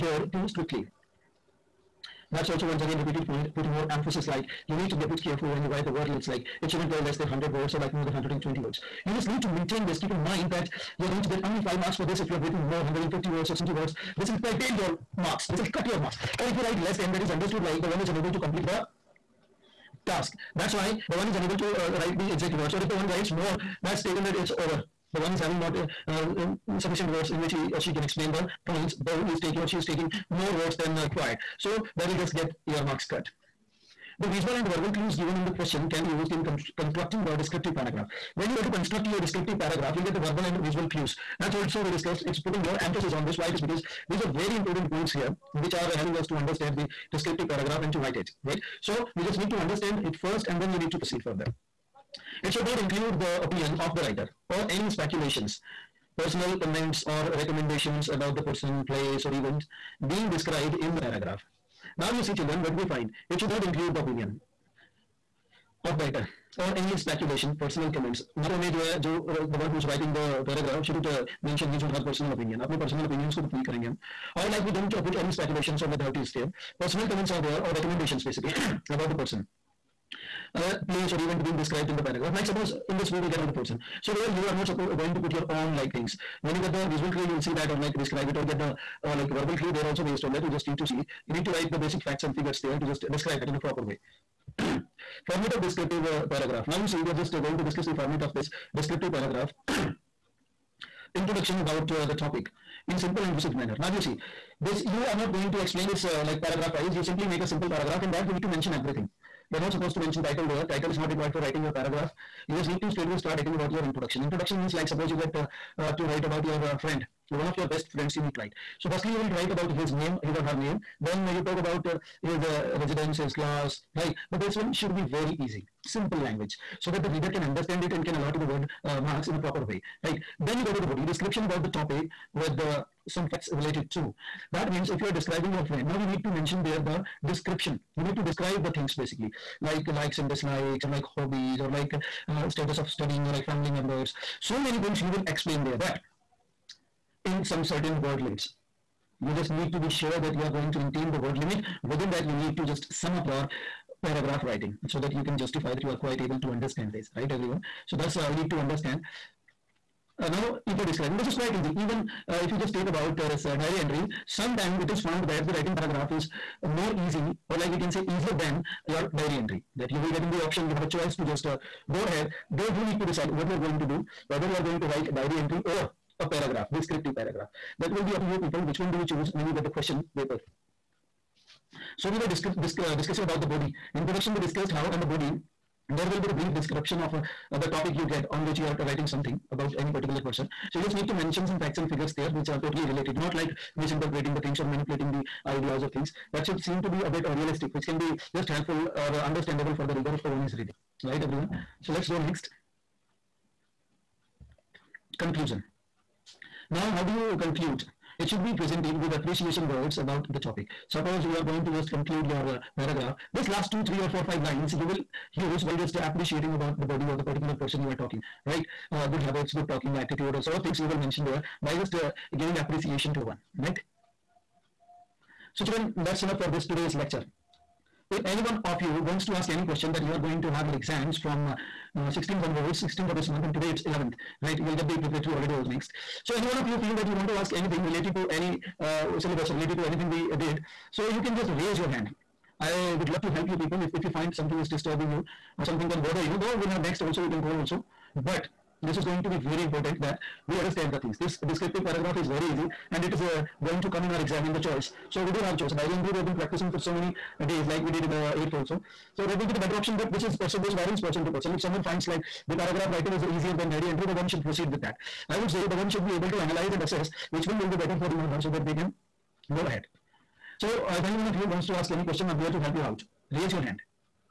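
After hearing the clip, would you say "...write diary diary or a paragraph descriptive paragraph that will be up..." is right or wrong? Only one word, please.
wrong.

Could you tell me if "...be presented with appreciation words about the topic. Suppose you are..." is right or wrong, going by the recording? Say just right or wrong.
right.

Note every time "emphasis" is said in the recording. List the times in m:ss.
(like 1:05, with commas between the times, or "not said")
0:03, 0:42.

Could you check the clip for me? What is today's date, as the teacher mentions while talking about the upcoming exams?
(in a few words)
11th.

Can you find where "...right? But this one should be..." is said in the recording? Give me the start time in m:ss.
2:03.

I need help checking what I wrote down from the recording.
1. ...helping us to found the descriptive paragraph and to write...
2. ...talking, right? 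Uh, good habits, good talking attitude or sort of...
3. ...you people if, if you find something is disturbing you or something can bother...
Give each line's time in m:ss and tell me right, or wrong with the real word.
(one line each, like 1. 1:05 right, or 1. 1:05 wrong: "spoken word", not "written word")
1. 0:45 wrong: "understand", not "found"
2. 3:37 right
3. 4:03 right.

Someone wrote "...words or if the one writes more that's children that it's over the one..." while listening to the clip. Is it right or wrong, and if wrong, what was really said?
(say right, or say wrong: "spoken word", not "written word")
wrong: "taken", not "children".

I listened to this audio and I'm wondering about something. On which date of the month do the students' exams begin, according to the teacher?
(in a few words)
16th.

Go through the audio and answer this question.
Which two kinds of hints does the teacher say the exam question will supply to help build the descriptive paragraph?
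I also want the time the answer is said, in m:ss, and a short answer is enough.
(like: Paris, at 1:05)
visual and verbal clues, at 0:34.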